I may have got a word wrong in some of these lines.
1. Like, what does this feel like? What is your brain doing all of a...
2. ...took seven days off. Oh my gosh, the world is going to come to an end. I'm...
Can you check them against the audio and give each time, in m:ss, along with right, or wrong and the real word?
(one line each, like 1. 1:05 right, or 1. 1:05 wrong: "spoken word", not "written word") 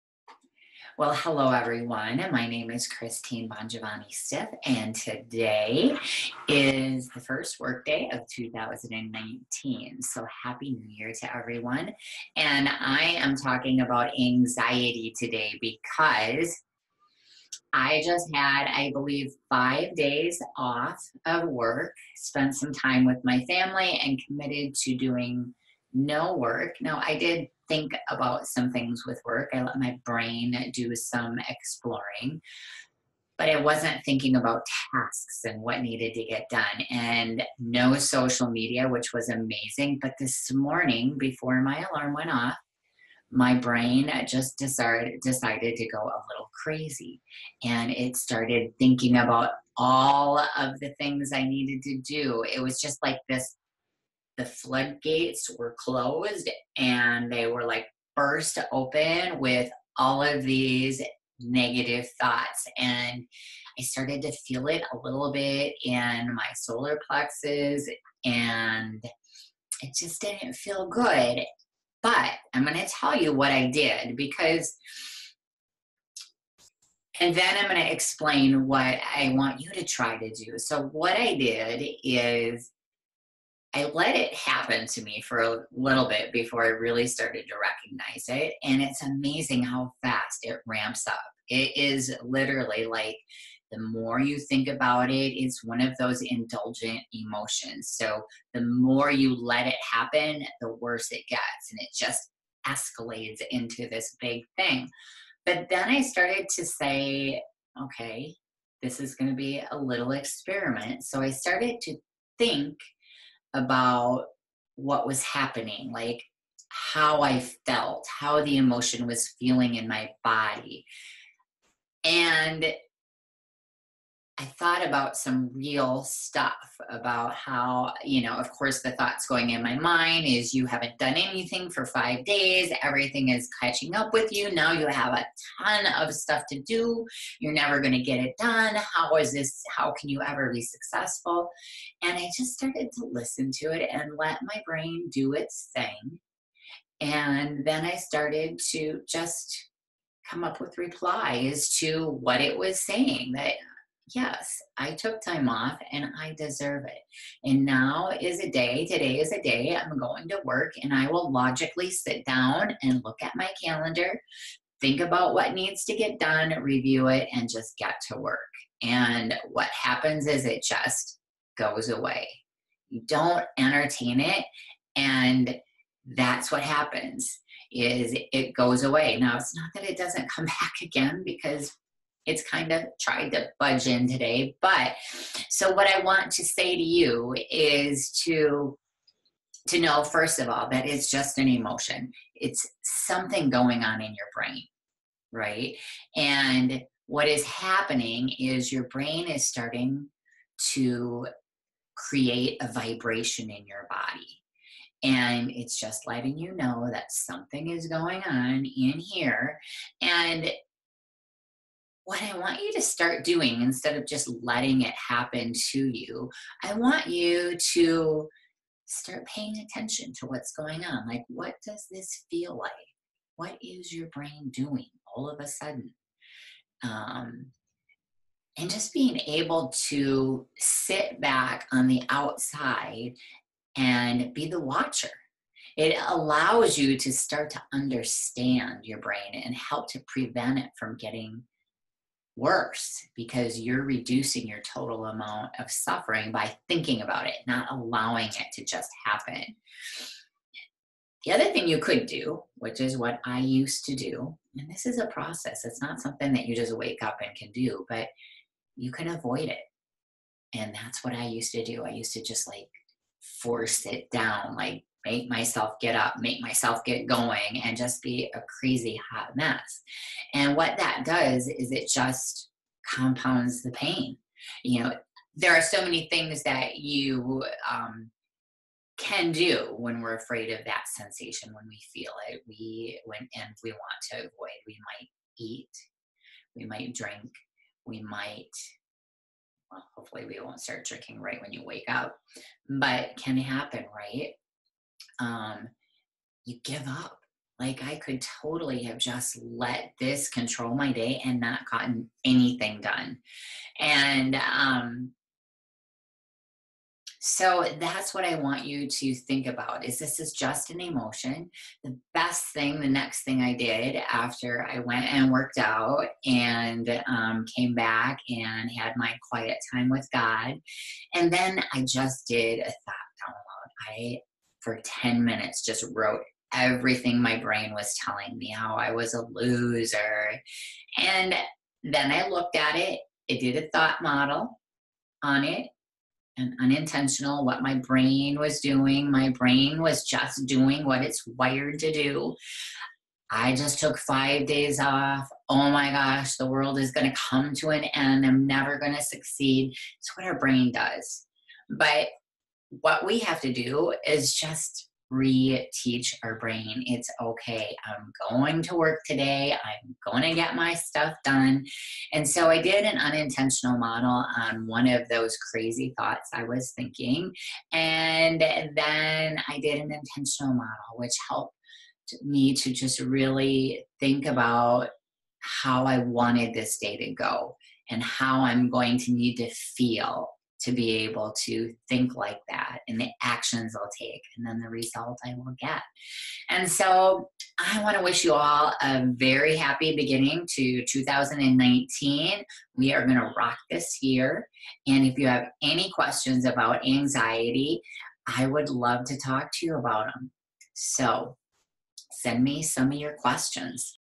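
1. 3:41 right
2. 5:43 wrong: "five", not "seven".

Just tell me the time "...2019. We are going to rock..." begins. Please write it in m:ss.
6:30.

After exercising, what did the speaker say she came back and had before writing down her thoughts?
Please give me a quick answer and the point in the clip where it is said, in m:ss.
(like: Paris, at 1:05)
Quiet time with God, at 5:19.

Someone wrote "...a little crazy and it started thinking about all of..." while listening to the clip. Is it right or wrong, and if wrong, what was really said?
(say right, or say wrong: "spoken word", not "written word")
right.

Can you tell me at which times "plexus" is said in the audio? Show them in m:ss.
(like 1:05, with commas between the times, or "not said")
1:07.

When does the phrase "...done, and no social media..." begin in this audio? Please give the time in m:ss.
0:36.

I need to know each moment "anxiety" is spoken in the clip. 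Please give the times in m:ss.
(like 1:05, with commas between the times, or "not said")
0:14, 6:36.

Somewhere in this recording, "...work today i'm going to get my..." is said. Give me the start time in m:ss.
5:58.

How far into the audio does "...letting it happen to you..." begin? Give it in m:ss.
3:34.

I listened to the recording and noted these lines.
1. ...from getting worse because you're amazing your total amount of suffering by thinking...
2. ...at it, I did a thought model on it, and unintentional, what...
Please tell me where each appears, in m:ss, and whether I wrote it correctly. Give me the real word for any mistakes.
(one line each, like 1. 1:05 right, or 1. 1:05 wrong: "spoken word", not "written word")
1. 4:00 wrong: "reducing", not "amazing"
2. 5:32 right.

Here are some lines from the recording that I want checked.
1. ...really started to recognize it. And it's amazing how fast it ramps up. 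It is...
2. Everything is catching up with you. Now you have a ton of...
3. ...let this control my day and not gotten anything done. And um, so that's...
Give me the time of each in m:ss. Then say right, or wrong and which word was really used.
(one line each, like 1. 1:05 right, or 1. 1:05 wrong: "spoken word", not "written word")
1. 1:26 right
2. 2:12 right
3. 4:59 right.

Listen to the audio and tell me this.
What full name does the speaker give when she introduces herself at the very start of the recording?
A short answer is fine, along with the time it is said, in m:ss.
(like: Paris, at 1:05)
Christine Bongiovanni Stiff, at 0:02.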